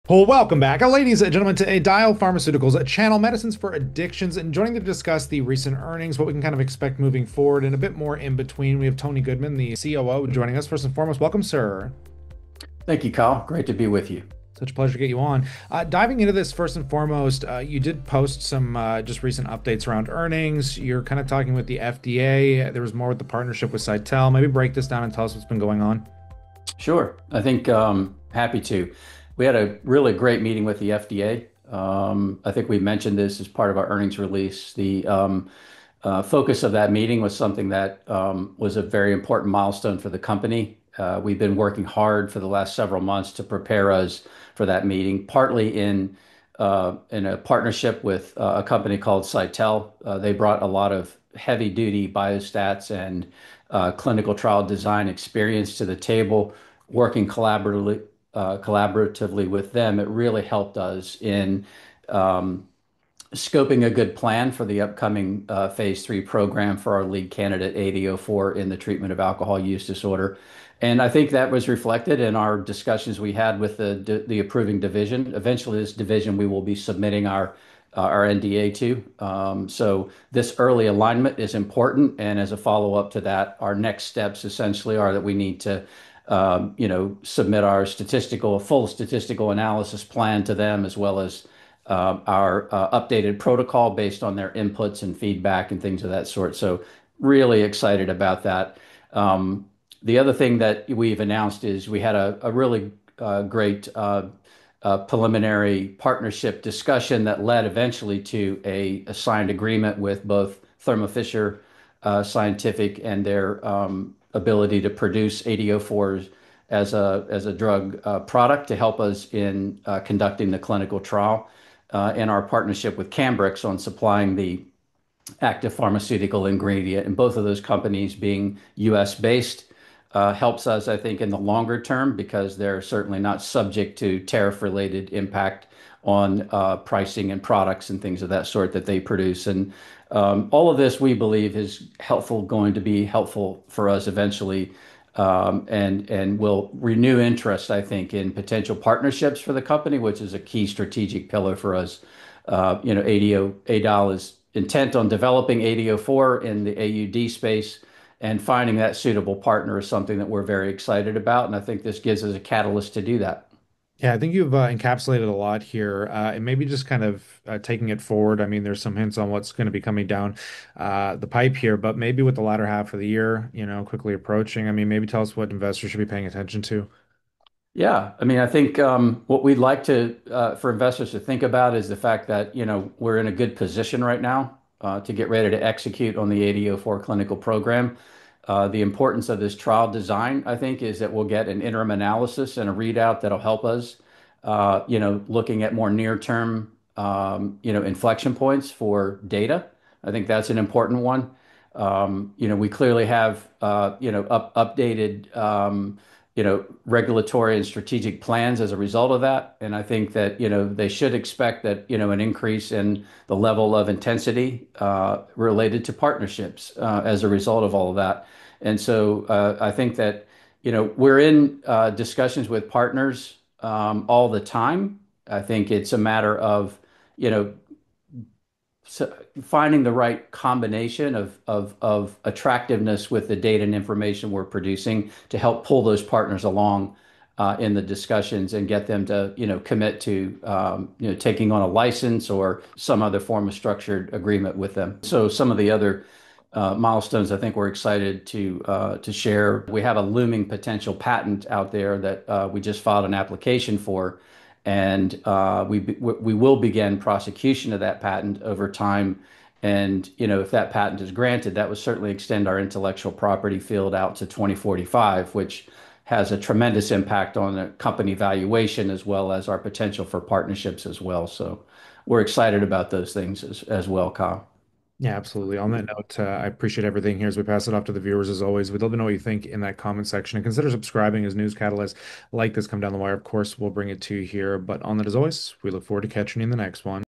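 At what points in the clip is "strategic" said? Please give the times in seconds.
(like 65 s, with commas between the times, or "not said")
150 s, 207 s.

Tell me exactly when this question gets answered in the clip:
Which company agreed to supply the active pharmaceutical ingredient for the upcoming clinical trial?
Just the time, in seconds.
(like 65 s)
123 s.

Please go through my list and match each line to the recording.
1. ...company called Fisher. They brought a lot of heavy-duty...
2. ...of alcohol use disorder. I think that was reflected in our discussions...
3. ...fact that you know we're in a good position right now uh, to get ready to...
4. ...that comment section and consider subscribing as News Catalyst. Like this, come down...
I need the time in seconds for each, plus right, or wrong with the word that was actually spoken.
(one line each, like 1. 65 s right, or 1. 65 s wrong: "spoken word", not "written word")
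1. 48 s wrong: "Cytel", not "Fisher"
2. 69 s right
3. 181 s right
4. 279 s right.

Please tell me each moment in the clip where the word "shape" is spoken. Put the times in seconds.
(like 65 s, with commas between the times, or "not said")
not said.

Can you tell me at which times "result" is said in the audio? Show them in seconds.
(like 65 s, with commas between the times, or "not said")
208 s, 217 s.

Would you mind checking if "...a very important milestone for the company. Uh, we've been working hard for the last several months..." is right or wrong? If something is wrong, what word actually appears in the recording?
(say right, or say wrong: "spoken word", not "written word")
right.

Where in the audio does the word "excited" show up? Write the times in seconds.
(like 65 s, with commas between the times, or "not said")
97 s, 160 s, 247 s, 272 s.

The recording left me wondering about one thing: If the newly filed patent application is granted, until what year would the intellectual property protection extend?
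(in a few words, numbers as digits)
2045.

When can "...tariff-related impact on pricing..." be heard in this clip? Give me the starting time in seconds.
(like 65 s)
134 s.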